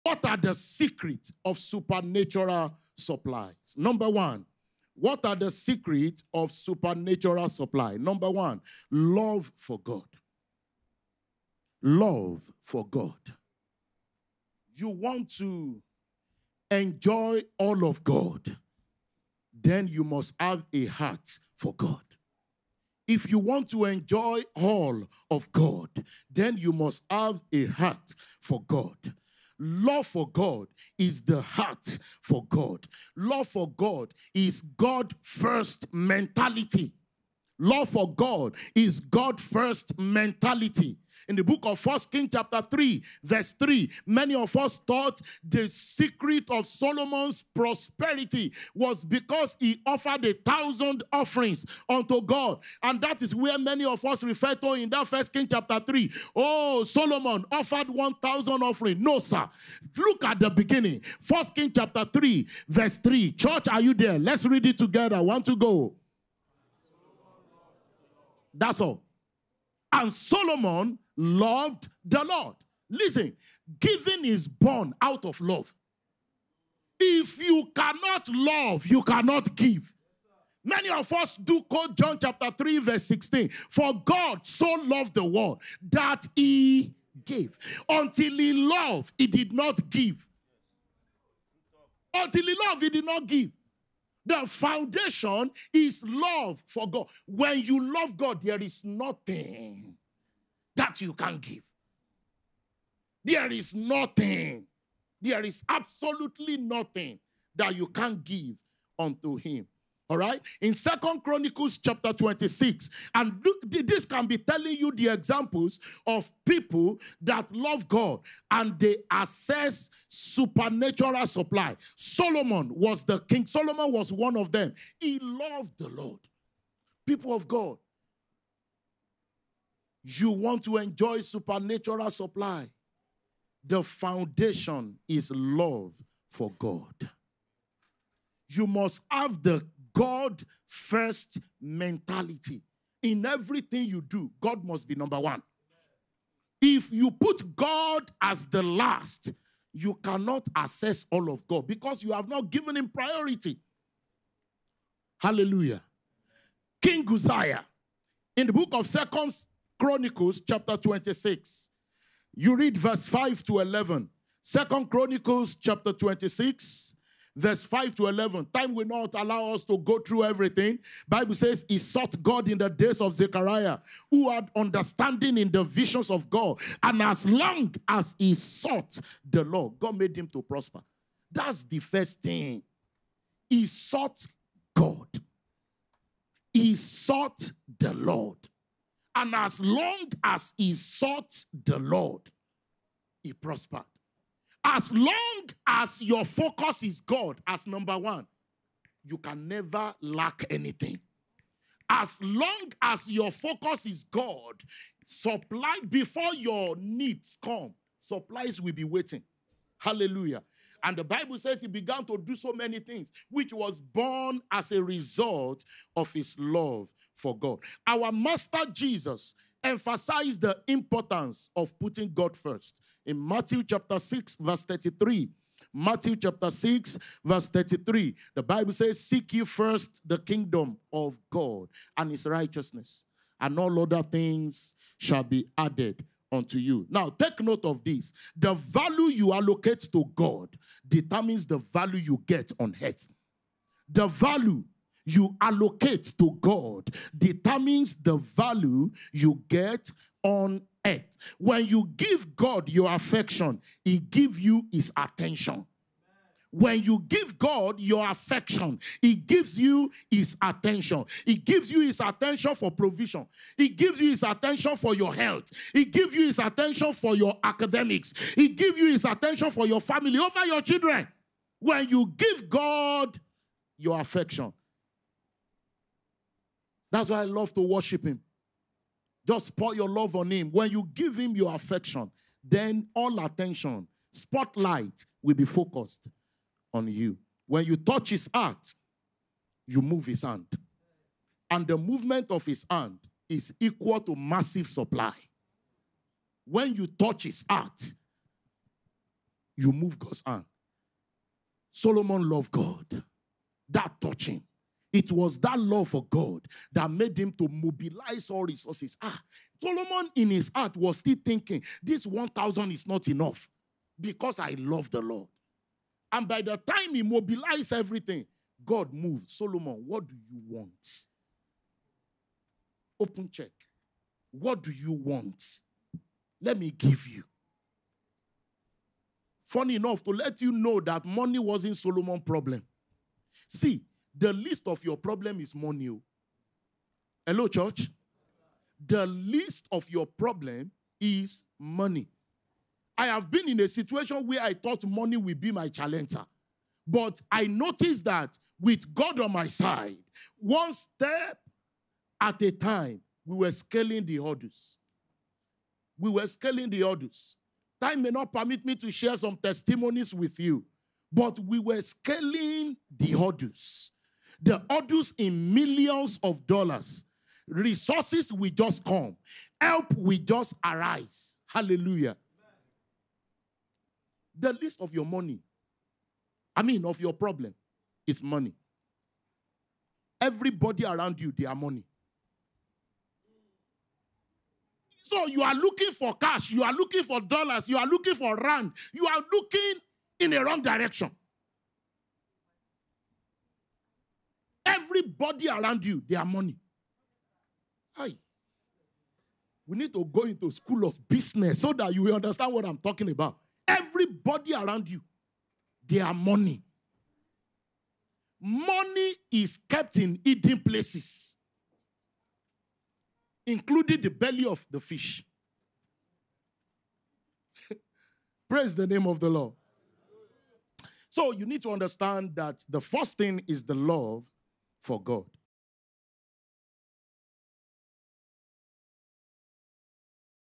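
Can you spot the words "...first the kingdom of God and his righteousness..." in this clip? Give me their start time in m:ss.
3:49.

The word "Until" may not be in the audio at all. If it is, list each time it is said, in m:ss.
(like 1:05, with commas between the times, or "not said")
1:27, 1:32.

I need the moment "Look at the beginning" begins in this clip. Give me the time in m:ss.
0:59.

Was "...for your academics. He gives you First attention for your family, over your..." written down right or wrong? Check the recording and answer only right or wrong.
wrong.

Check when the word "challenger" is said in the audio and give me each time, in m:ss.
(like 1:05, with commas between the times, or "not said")
5:45.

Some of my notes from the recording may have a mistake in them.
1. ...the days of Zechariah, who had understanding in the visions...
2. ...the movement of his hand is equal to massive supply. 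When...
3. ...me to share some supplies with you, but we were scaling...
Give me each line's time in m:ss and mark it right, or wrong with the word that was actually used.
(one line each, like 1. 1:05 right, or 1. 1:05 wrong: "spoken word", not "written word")
1. 2:52 right
2. 4:51 right
3. 5:58 wrong: "testimonies", not "supplies".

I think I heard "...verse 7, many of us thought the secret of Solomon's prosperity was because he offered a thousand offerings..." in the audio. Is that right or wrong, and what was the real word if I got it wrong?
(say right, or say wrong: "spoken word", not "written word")
wrong: "3", not "7".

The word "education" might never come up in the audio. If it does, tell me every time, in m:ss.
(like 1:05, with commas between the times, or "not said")
not said.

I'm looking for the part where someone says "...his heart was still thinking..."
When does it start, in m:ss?
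5:10.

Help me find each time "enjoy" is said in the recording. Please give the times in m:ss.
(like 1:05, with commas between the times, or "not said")
0:16, 0:23, 2:10.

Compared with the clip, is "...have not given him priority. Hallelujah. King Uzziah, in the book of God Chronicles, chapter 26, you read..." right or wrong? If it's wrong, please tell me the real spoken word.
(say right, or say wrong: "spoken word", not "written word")
wrong: "Second", not "God".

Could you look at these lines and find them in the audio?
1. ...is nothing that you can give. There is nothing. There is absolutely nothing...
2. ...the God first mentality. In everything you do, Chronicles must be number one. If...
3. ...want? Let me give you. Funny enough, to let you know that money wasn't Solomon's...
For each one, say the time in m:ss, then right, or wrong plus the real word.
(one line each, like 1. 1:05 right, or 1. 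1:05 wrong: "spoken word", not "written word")
1. 1:38 right
2. 2:19 wrong: "God", not "Chronicles"
3. 5:24 right.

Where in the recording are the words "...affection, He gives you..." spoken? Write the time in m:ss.
4:18.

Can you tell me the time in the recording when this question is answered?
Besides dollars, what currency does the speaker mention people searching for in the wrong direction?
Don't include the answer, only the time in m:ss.
6:28.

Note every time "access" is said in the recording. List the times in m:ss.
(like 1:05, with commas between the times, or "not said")
1:59.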